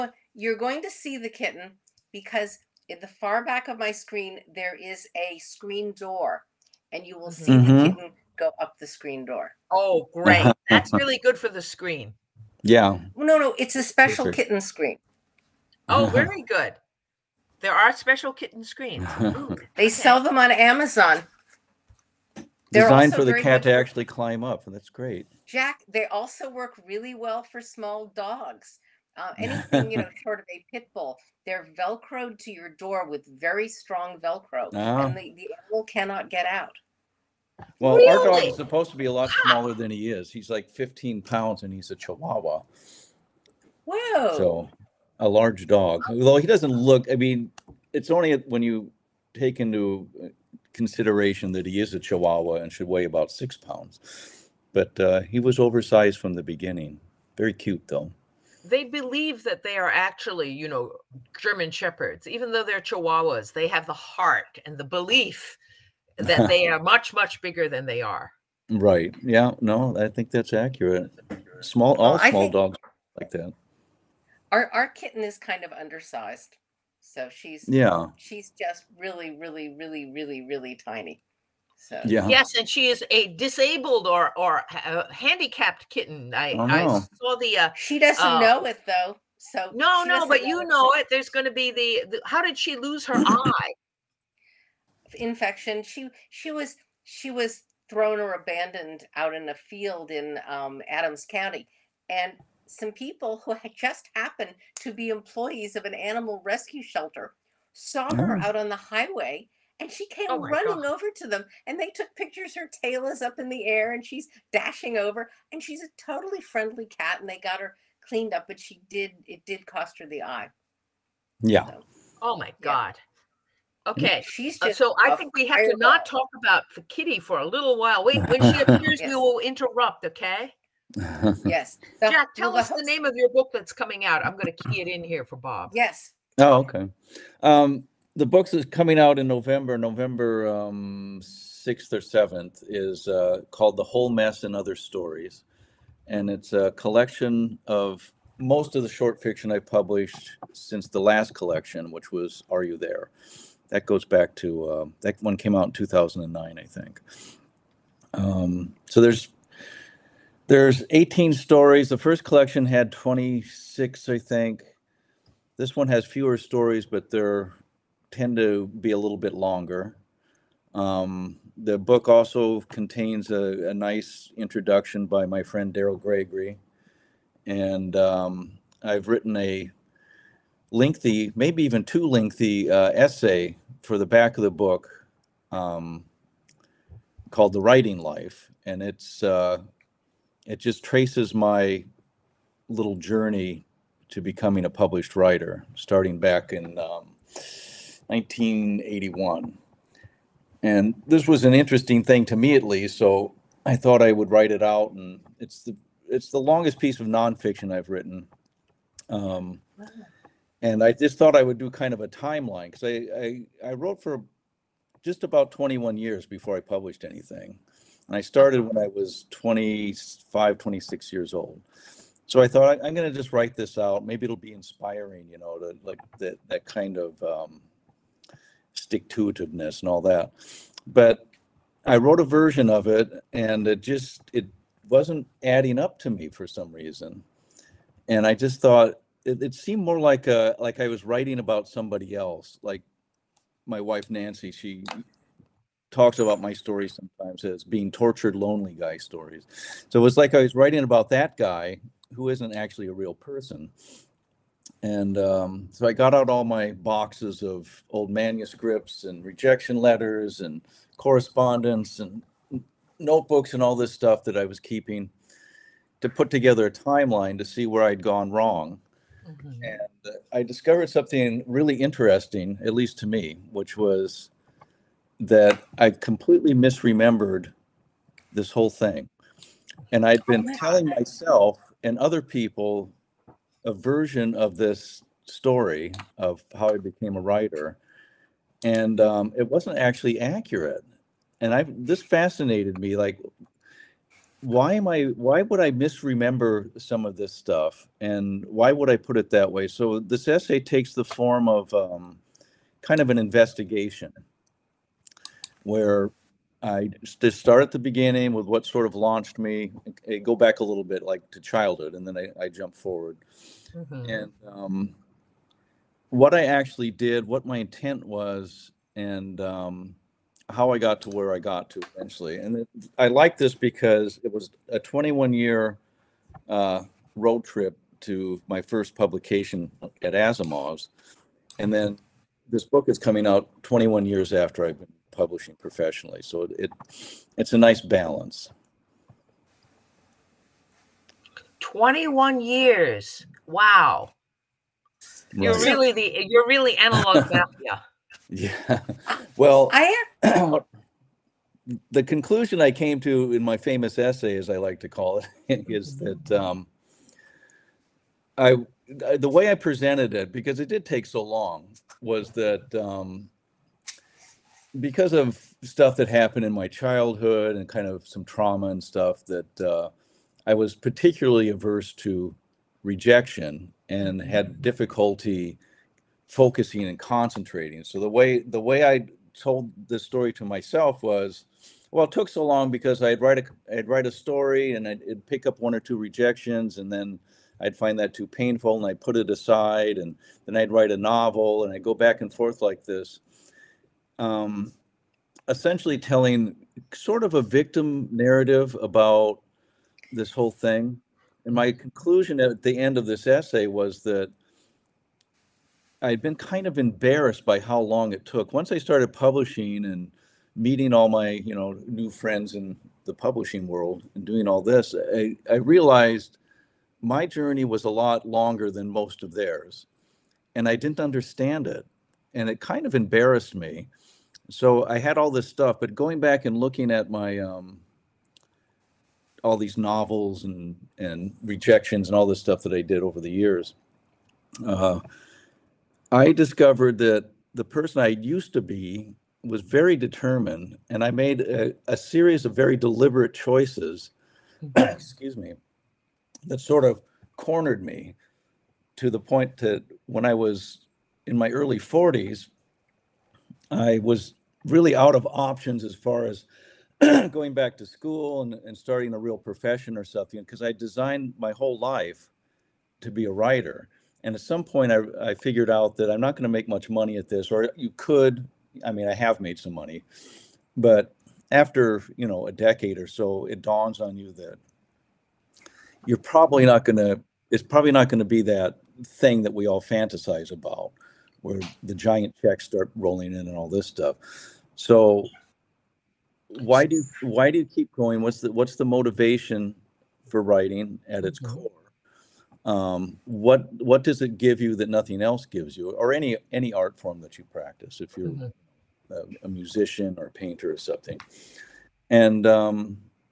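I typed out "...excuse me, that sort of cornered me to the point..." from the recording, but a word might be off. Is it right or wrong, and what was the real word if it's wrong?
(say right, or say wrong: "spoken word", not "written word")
right.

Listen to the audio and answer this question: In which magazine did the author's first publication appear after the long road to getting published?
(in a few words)
Asimov's.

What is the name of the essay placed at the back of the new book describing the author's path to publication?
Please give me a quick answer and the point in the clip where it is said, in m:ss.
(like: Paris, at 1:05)
The Writing Life, at 3:07.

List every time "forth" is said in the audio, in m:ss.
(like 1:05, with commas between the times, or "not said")
6:32.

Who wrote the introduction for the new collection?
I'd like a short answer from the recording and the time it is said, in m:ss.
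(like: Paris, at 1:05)
Daryl Gregory, at 2:55.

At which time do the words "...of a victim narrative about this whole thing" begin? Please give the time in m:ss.
6:37.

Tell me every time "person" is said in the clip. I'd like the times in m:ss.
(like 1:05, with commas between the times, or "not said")
4:13, 7:17.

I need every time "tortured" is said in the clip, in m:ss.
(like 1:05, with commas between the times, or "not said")
4:07.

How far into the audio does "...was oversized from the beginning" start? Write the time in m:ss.
0:55.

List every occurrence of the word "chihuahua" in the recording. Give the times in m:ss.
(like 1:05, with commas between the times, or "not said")
0:41, 0:51, 1:02.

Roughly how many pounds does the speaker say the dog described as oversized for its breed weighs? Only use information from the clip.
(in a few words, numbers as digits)
15.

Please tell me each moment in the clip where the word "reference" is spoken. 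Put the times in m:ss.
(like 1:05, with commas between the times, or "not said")
not said.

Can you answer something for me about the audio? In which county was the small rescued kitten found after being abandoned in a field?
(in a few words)
Adams County.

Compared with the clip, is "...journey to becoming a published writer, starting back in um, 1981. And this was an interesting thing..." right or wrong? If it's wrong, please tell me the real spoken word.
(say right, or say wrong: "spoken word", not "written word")
right.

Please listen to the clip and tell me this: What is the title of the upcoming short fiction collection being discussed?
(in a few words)
The Whole Mess and Other Stories.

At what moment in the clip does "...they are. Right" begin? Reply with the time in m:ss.
1:07.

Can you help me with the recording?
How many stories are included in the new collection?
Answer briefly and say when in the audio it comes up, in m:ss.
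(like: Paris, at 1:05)
18, at 2:40.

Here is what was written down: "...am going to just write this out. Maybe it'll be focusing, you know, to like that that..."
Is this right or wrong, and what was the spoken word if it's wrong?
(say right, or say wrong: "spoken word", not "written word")
wrong: "inspiring", not "focusing".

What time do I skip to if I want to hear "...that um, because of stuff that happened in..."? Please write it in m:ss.
6:02.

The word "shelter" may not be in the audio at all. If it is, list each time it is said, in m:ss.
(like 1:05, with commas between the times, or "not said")
1:46.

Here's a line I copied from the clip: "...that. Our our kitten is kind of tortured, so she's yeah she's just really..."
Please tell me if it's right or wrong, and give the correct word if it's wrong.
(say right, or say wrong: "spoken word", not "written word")
wrong: "undersized", not "tortured".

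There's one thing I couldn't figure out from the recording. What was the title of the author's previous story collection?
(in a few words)
Are You There?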